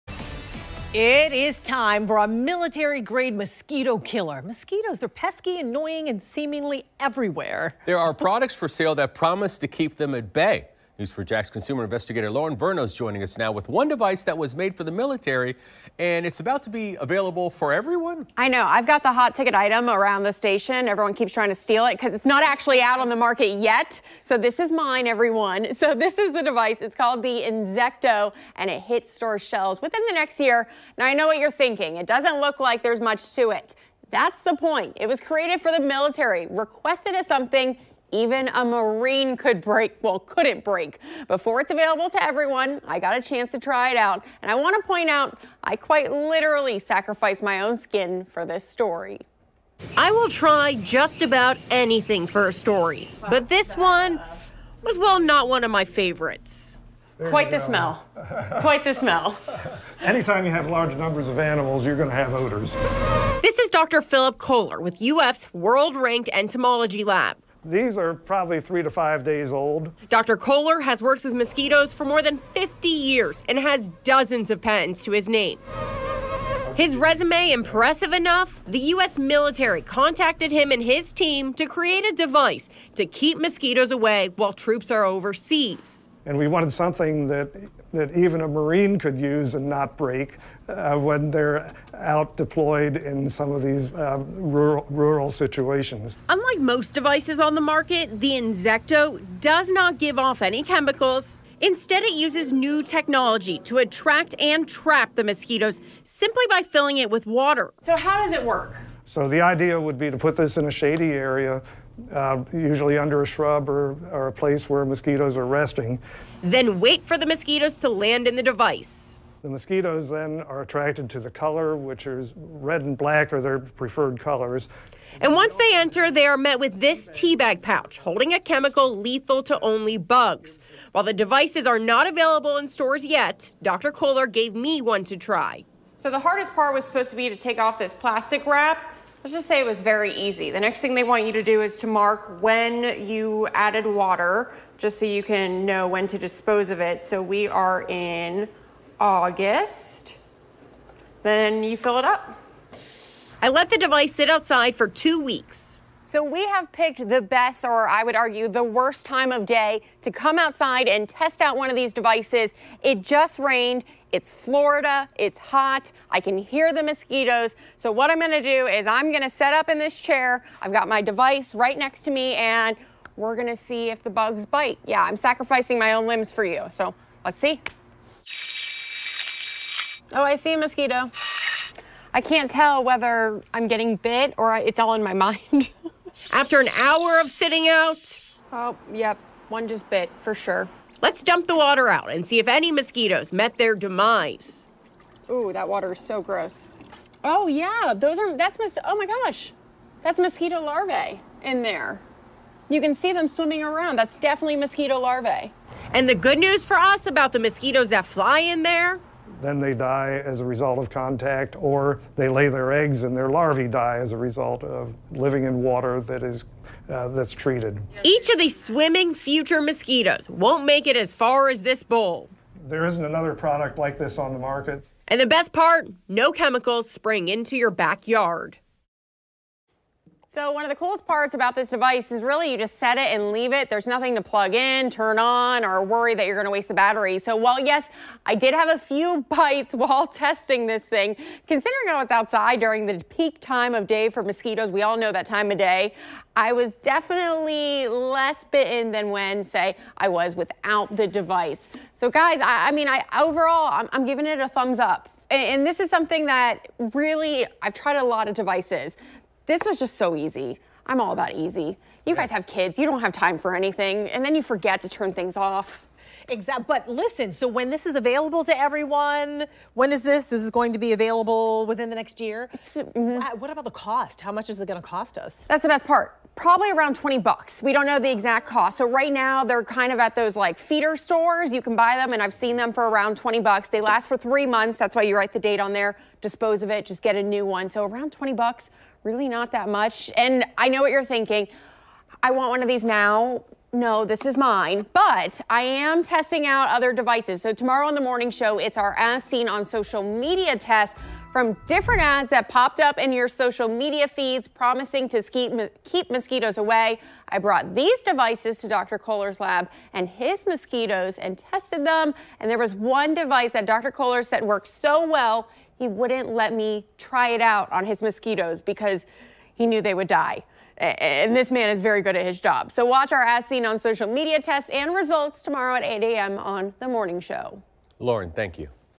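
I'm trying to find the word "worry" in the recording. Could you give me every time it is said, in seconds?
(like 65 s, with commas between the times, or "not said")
235 s.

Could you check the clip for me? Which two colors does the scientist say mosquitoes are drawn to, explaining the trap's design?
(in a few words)
red and black.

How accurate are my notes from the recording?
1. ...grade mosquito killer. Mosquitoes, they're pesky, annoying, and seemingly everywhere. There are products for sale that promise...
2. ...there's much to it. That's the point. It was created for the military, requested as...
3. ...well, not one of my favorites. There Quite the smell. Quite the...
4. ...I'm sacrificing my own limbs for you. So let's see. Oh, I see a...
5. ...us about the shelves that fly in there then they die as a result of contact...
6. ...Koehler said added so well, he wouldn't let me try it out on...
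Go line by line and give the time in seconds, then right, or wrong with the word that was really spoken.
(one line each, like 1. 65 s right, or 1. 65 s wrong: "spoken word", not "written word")
1. 2 s right
2. 32 s right
3. 54 s right
4. 175 s right
5. 206 s wrong: "mosquitoes", not "shelves"
6. 313 s wrong: "worked", not "added".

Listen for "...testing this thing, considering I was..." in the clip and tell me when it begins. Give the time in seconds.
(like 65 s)
240 s.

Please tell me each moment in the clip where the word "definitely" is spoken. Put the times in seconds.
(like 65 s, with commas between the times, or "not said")
204 s, 246 s.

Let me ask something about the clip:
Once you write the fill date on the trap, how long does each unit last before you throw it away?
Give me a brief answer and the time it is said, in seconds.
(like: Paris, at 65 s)
3 months, at 284 s.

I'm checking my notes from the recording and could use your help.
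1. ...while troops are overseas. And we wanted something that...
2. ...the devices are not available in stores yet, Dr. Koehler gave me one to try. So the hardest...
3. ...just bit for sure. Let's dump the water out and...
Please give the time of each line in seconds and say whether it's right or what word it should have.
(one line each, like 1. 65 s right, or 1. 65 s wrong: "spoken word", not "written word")
1. 84 s right
2. 131 s right
3. 189 s right.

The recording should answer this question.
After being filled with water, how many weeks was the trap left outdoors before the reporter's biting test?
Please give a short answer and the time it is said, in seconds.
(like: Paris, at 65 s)
2 weeks, at 154 s.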